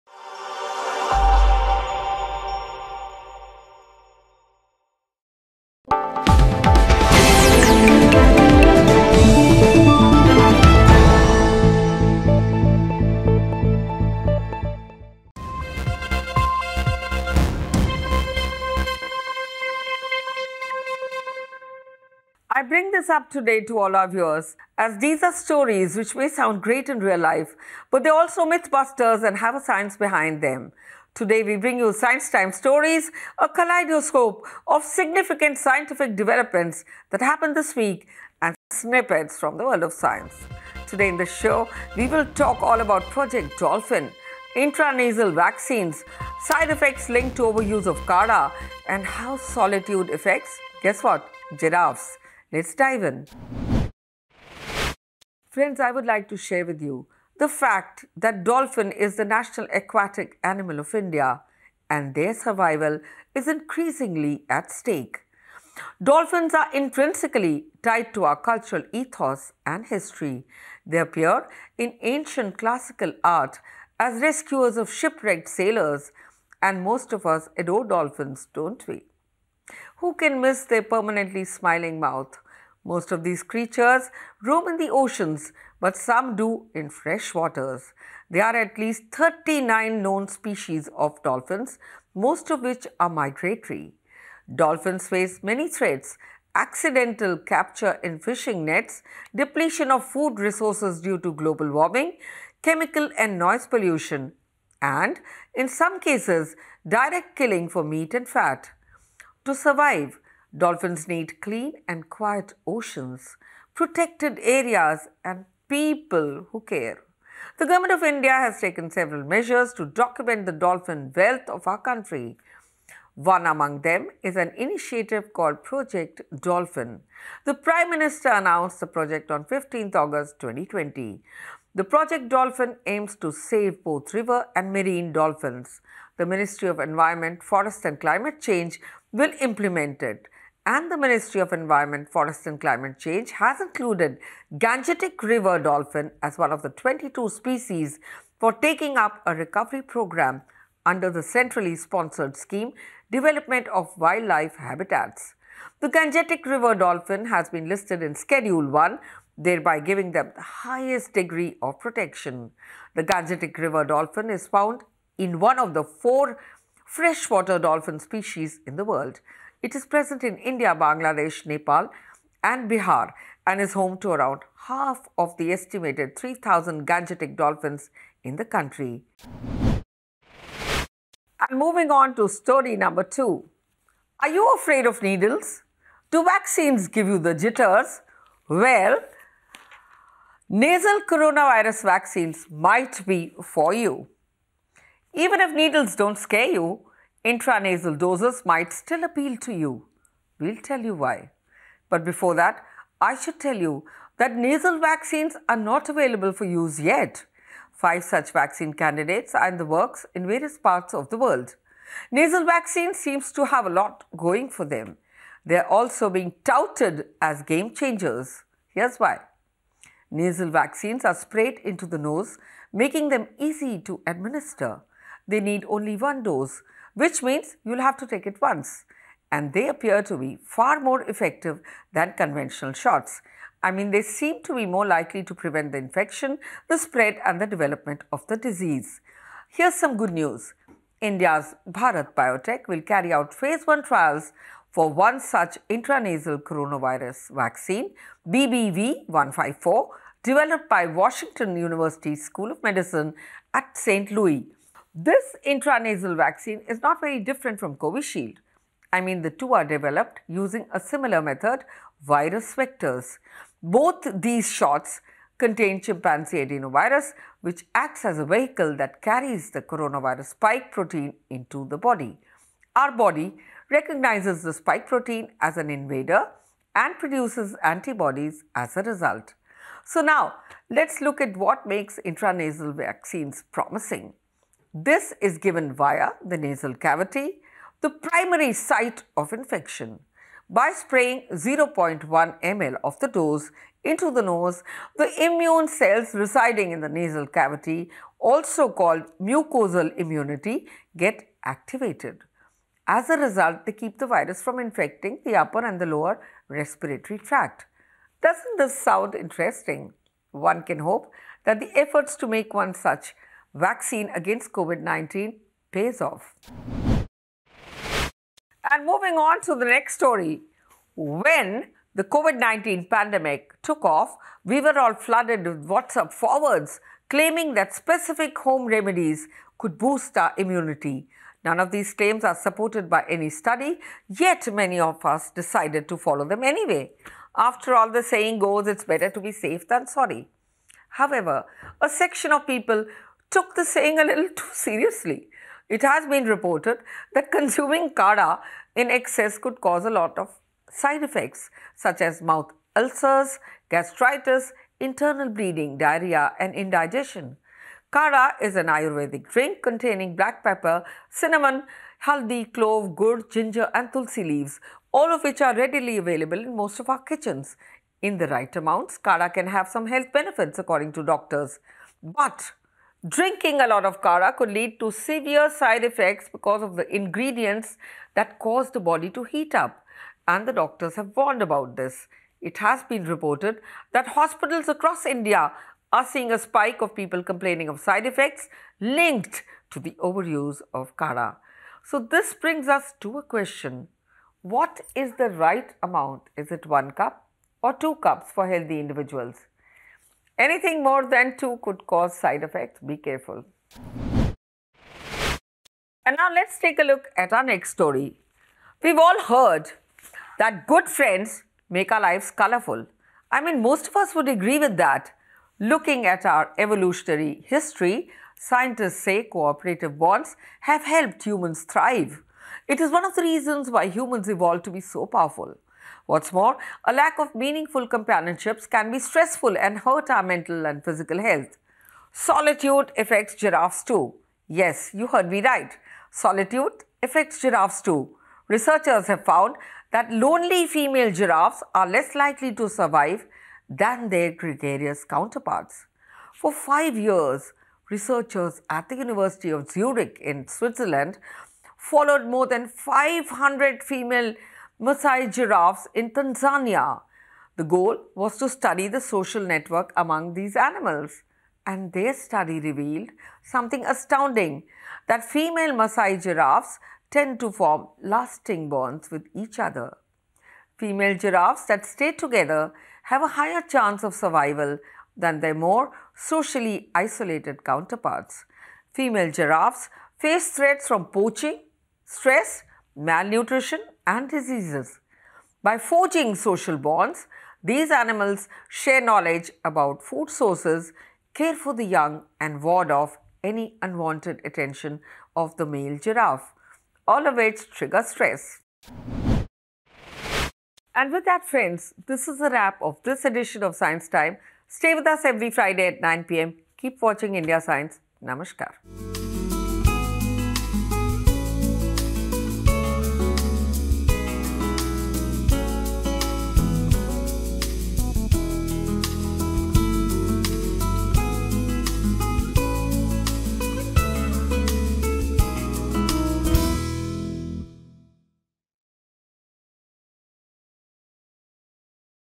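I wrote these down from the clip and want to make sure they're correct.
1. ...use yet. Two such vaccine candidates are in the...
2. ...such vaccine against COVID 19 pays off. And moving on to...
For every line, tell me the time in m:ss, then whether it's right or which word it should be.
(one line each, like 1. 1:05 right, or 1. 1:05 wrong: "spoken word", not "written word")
1. 3:26 wrong: "Five", not "Two"
2. 5:12 right.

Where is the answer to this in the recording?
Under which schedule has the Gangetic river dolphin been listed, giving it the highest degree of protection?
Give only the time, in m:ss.
2:38.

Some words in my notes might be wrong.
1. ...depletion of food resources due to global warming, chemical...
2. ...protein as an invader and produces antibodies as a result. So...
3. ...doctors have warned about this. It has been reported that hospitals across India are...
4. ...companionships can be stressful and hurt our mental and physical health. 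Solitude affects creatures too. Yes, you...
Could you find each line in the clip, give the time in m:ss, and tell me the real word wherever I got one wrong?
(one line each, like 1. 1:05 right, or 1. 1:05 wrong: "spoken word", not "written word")
1. 1:39 right
2. 4:34 right
3. 6:20 right
4. 7:07 wrong: "giraffes", not "creatures".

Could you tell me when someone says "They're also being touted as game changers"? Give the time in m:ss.
3:35.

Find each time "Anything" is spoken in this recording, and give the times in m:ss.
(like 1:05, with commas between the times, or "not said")
6:40.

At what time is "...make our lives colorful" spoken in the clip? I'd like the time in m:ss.
6:51.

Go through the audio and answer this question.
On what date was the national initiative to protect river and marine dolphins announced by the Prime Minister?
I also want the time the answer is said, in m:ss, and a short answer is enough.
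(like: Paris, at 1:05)
15th August 2020, at 2:09.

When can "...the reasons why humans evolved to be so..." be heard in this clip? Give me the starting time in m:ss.
7:03.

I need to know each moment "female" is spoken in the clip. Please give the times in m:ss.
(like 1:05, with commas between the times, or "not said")
7:20, 7:33, 7:45, 7:50, 7:58.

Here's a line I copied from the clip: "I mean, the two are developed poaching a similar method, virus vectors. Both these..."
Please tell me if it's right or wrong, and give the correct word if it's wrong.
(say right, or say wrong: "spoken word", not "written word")
wrong: "using", not "poaching".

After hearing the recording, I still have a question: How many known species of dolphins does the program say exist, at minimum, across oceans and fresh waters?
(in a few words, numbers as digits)
39.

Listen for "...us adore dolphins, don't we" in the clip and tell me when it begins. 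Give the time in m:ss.
1:17.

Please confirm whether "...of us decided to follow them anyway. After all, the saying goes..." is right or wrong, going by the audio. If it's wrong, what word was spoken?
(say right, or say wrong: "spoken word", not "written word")
right.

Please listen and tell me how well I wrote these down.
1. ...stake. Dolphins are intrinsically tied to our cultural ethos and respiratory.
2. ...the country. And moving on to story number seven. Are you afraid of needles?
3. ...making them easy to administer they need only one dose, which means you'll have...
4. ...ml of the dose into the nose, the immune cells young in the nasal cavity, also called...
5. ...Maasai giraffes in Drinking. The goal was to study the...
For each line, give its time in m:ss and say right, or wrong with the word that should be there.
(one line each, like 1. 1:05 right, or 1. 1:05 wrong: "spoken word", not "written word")
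1. 1:04 wrong: "history", not "respiratory"
2. 2:58 wrong: "two", not "seven"
3. 3:42 right
4. 4:52 wrong: "residing", not "young"
5. 7:34 wrong: "Tanzania", not "Drinking".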